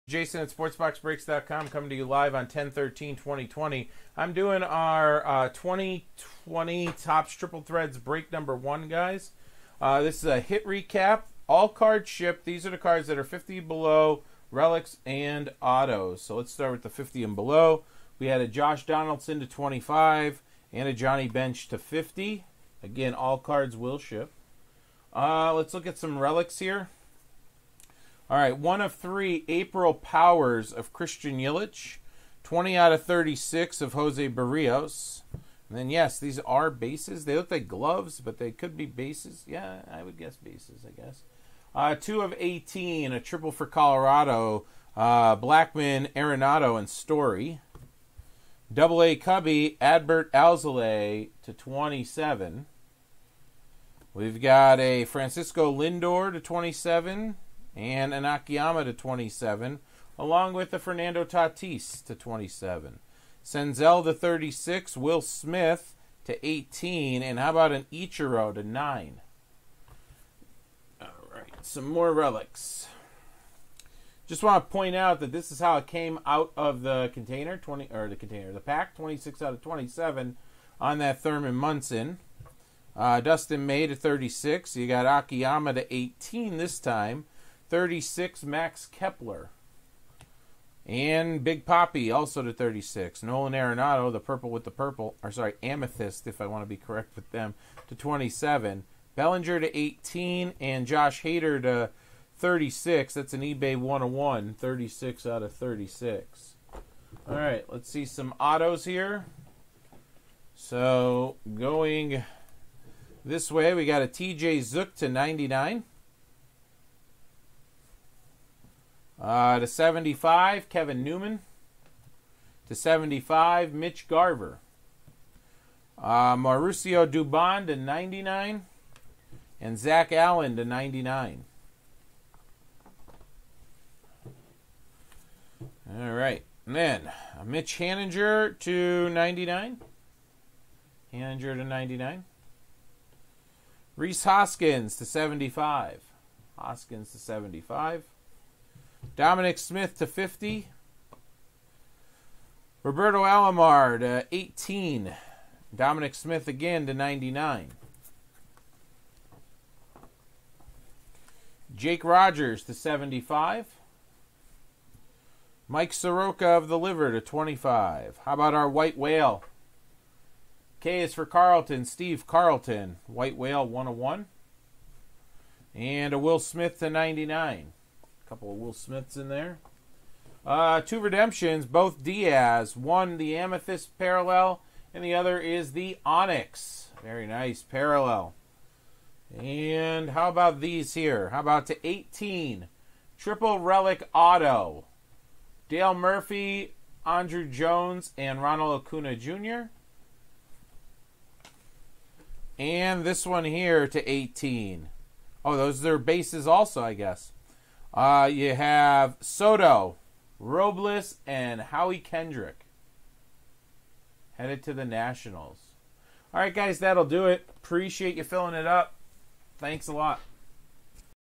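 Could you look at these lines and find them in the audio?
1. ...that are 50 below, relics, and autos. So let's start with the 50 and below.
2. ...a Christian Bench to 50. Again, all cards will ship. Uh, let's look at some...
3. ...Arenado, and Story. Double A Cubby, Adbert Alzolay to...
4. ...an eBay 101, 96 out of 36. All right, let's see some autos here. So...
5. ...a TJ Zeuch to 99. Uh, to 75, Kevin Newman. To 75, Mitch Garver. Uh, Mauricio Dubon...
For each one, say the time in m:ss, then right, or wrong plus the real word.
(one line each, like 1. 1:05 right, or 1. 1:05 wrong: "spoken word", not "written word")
1. 0:13 right
2. 0:20 wrong: "Johnny", not "Christian"
3. 0:46 right
4. 1:43 wrong: "36", not "96"
5. 1:54 right.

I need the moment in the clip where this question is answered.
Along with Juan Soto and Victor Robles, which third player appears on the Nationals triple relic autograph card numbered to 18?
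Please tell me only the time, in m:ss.
3:31.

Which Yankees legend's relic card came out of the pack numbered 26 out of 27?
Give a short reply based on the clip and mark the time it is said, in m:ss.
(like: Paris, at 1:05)
Thurman Munson, at 1:21.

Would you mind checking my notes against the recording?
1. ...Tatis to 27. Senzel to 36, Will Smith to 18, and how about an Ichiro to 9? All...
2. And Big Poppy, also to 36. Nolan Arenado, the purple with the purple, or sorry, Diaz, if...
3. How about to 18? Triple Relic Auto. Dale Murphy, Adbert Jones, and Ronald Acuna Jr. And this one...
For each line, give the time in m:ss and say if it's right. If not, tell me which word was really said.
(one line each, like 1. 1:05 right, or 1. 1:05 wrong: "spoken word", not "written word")
1. 1:01 right
2. 1:30 wrong: "Amethyst", not "Diaz"
3. 3:11 wrong: "Andruw", not "Adbert".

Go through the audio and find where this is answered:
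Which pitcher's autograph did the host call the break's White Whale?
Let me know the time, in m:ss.
2:51.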